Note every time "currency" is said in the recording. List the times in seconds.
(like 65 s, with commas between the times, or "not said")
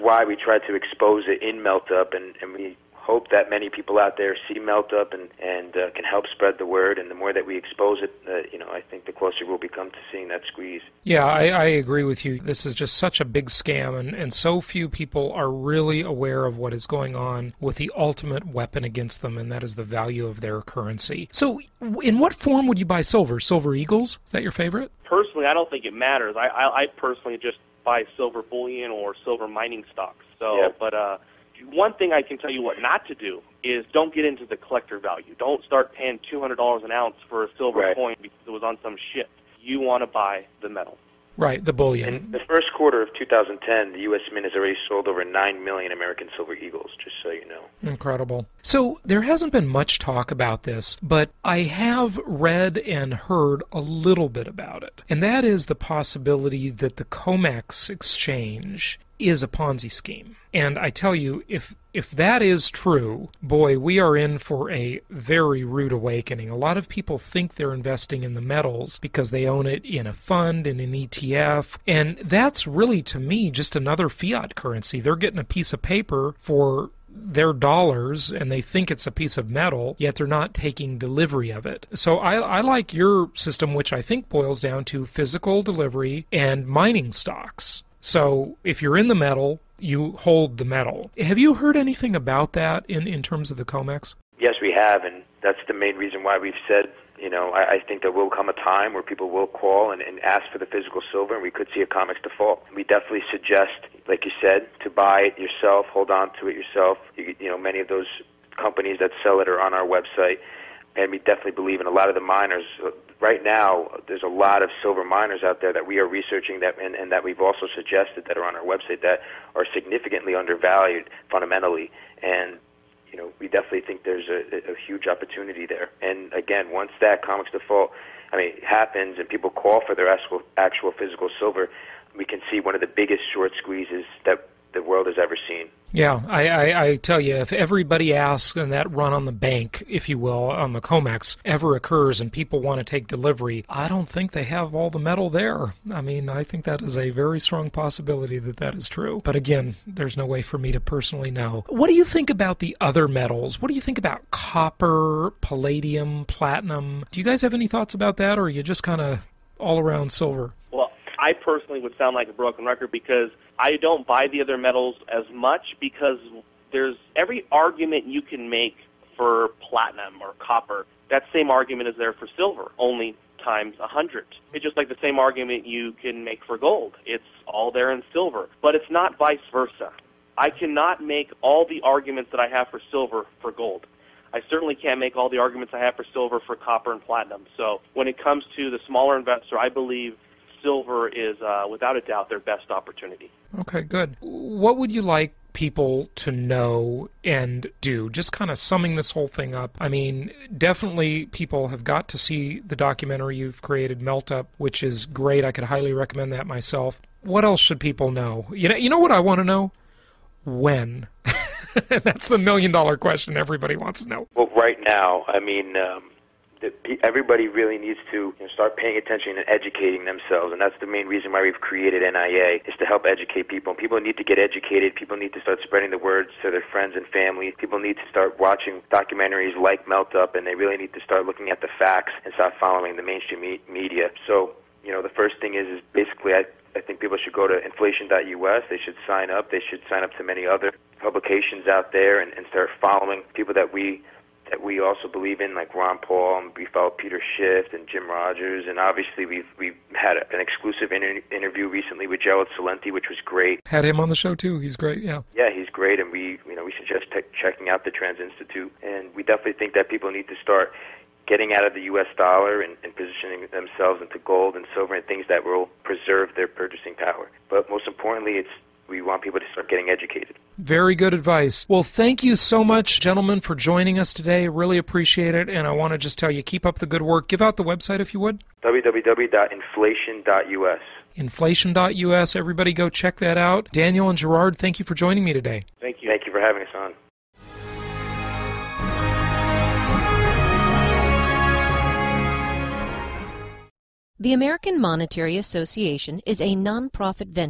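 20 s, 74 s.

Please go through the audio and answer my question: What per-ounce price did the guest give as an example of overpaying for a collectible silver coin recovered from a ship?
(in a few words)
$200.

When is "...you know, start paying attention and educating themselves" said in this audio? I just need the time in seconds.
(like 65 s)
218 s.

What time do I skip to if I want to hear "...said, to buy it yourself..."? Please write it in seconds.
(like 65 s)
104 s.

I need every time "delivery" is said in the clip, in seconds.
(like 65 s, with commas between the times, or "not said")
80 s, 85 s, 143 s.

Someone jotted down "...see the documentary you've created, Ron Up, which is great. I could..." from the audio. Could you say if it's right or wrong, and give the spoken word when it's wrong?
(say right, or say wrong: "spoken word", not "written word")
wrong: "Melt", not "Ron".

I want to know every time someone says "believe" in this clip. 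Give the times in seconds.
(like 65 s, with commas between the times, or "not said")
111 s, 189 s, 245 s.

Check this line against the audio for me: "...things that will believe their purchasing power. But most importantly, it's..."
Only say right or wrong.
wrong.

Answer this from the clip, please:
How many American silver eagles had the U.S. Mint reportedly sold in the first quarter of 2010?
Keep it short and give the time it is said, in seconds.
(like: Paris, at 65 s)
Over 9 million, at 45 s.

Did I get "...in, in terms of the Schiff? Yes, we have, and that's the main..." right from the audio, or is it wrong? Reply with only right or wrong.
wrong.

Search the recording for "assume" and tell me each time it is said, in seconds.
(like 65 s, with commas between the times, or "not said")
not said.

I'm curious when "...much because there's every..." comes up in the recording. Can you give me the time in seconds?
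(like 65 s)
165 s.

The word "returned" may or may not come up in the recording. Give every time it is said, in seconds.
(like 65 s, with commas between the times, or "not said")
not said.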